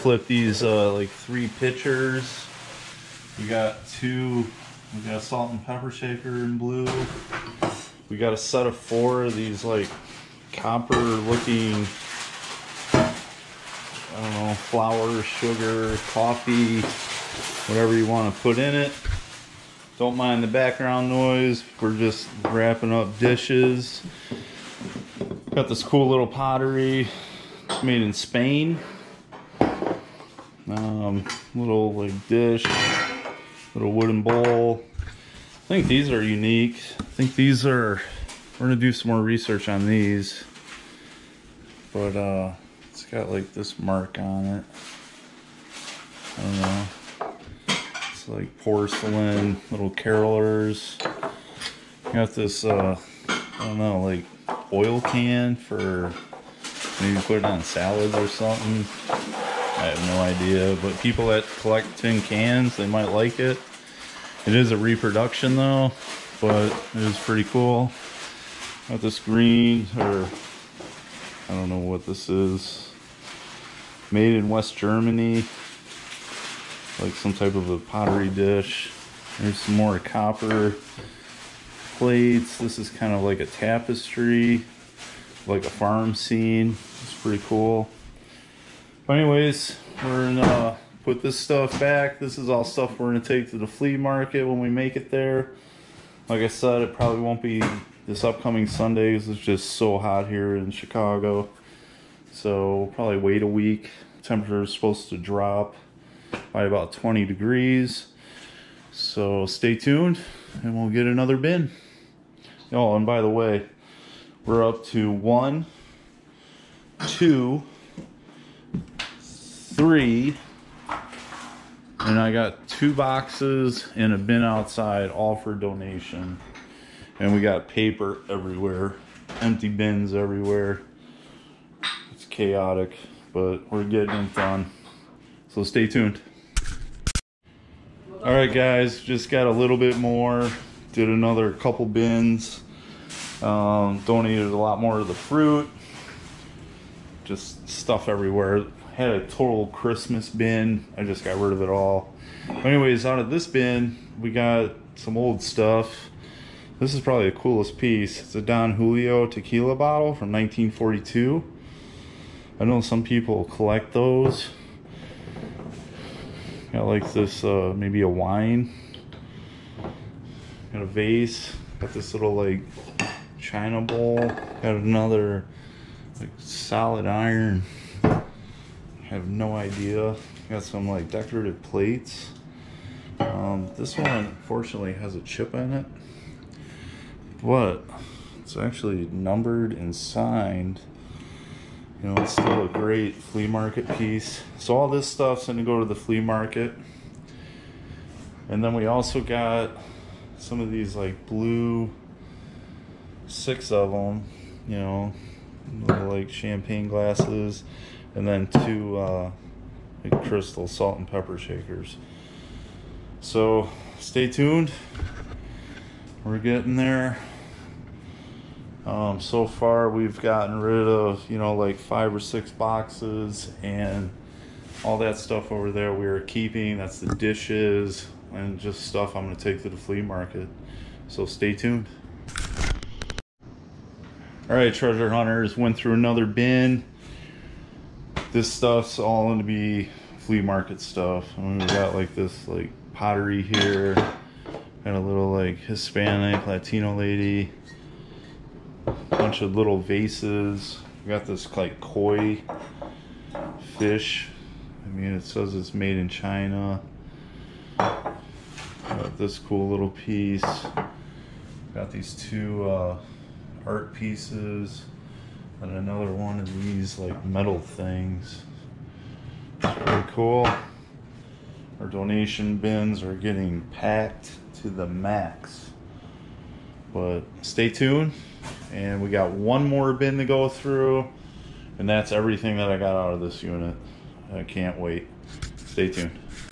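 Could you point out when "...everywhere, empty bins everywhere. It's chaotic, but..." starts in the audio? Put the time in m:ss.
2:08.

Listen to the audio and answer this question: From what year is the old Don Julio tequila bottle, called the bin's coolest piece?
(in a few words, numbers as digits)
1942.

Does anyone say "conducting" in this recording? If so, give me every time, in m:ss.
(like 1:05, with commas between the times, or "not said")
not said.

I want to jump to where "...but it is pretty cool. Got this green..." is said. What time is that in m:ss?
1:06.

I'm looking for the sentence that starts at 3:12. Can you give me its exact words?
You know, it's still a great flea market piece.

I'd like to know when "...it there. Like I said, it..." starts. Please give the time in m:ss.
1:34.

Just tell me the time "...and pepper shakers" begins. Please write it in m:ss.
3:30.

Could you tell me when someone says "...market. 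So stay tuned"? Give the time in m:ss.
3:50.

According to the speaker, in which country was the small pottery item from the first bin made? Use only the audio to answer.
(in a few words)
Spain.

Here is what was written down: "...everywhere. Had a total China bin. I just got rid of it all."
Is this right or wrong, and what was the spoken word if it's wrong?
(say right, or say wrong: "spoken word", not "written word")
wrong: "Christmas", not "China".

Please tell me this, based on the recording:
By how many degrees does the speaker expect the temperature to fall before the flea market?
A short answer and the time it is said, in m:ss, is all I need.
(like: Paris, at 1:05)
20, at 1:46.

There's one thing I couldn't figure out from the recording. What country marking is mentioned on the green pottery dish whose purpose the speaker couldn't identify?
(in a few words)
West Germany.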